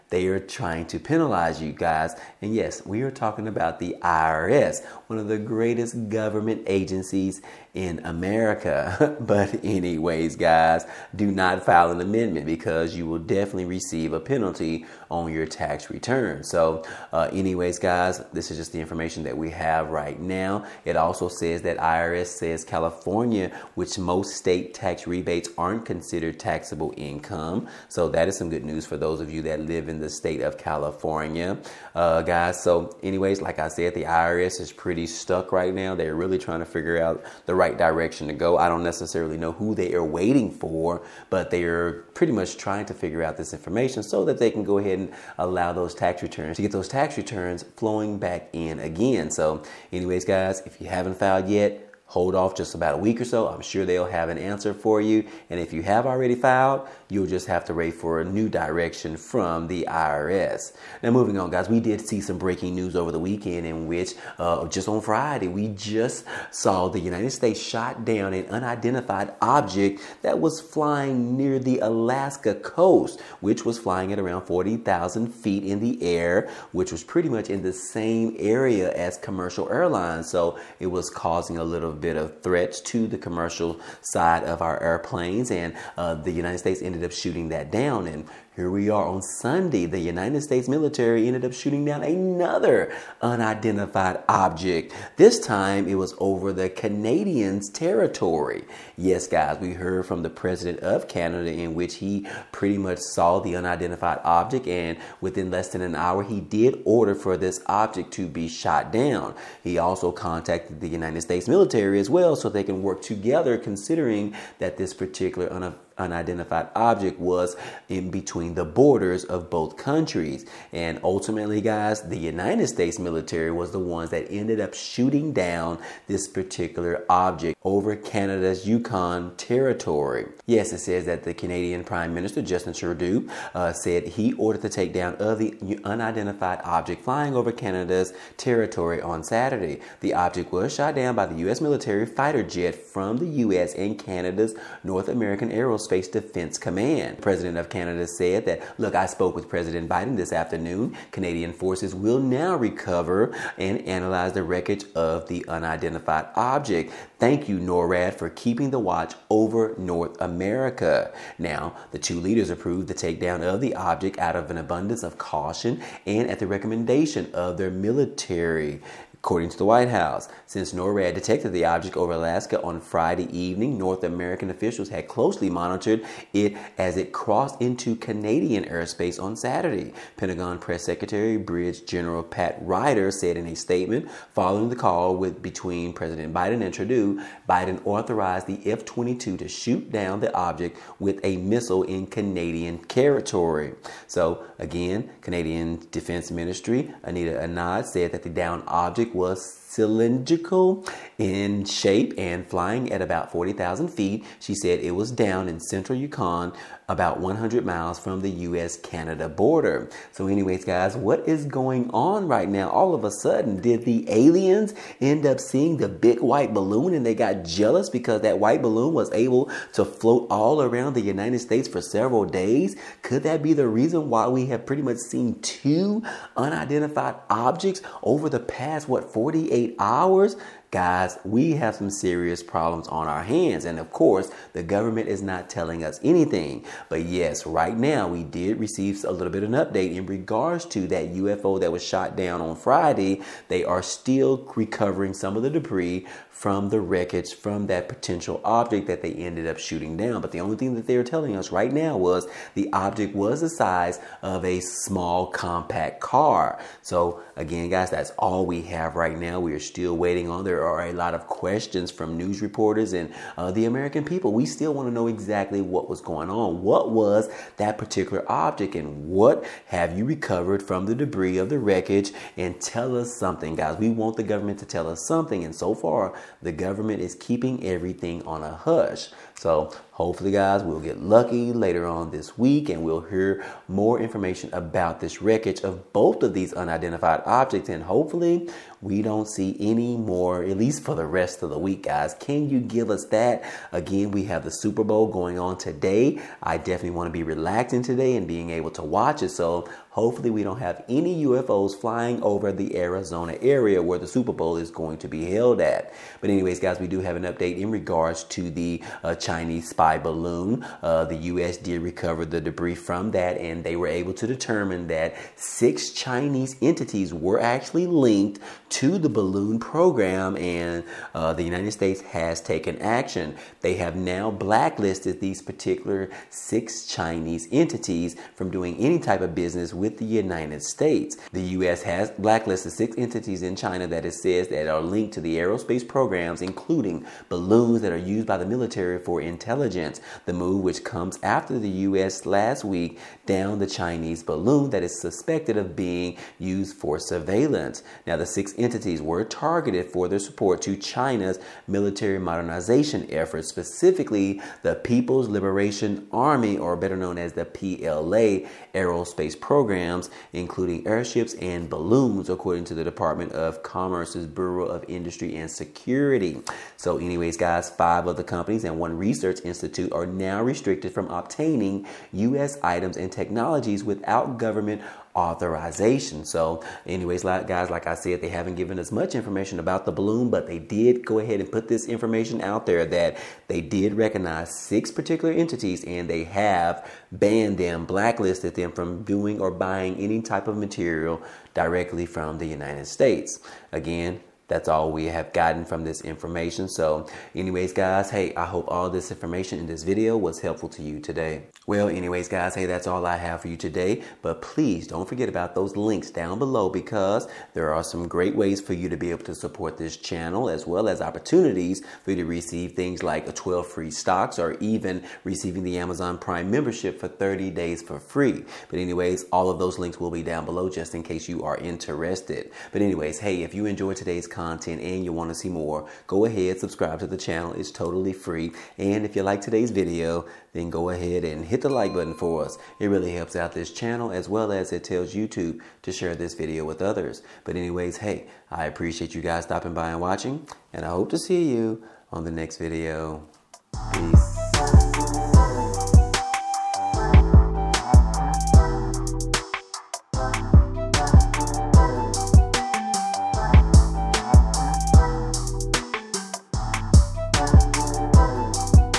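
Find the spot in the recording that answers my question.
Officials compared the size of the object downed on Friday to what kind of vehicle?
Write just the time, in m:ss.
4:14.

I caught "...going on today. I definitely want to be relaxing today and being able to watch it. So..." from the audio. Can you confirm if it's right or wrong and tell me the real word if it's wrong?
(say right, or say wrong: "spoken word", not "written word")
right.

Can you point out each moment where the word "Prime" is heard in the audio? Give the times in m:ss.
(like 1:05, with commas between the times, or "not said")
2:11, 6:56.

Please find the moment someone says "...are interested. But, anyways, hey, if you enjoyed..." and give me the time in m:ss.
7:01.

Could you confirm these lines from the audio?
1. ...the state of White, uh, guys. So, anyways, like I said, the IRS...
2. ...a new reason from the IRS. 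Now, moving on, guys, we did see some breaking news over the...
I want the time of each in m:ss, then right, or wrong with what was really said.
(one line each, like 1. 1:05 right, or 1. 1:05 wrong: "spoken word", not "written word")
1. 0:29 wrong: "California", not "White"
2. 0:58 wrong: "direction", not "reason".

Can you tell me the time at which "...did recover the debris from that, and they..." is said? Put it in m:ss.
5:11.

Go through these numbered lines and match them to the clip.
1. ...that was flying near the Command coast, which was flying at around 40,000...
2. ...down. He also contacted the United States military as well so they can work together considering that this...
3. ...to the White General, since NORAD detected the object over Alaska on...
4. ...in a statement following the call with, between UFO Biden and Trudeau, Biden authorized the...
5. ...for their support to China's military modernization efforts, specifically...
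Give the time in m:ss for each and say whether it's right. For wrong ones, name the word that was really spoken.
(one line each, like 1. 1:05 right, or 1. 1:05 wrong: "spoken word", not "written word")
1. 1:10 wrong: "Alaska", not "Command"
2. 1:48 right
3. 2:49 wrong: "House", not "General"
4. 3:03 wrong: "President", not "UFO"
5. 5:49 right.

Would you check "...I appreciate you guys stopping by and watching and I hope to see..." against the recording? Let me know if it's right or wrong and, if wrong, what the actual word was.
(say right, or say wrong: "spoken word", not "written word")
right.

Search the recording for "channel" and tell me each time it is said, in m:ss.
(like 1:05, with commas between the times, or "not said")
6:49, 7:07, 7:13.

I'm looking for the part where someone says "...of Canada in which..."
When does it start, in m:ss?
1:40.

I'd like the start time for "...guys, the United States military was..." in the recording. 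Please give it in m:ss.
2:01.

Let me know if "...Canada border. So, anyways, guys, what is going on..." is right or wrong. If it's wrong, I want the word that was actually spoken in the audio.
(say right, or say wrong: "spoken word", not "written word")
right.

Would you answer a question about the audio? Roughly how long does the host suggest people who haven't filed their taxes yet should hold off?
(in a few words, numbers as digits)
about a week.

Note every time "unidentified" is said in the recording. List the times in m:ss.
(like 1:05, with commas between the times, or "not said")
1:08, 1:33, 1:43, 1:55, 2:15, 2:35, 3:46, 4:46.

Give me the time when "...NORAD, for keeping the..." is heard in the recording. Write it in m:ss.
2:37.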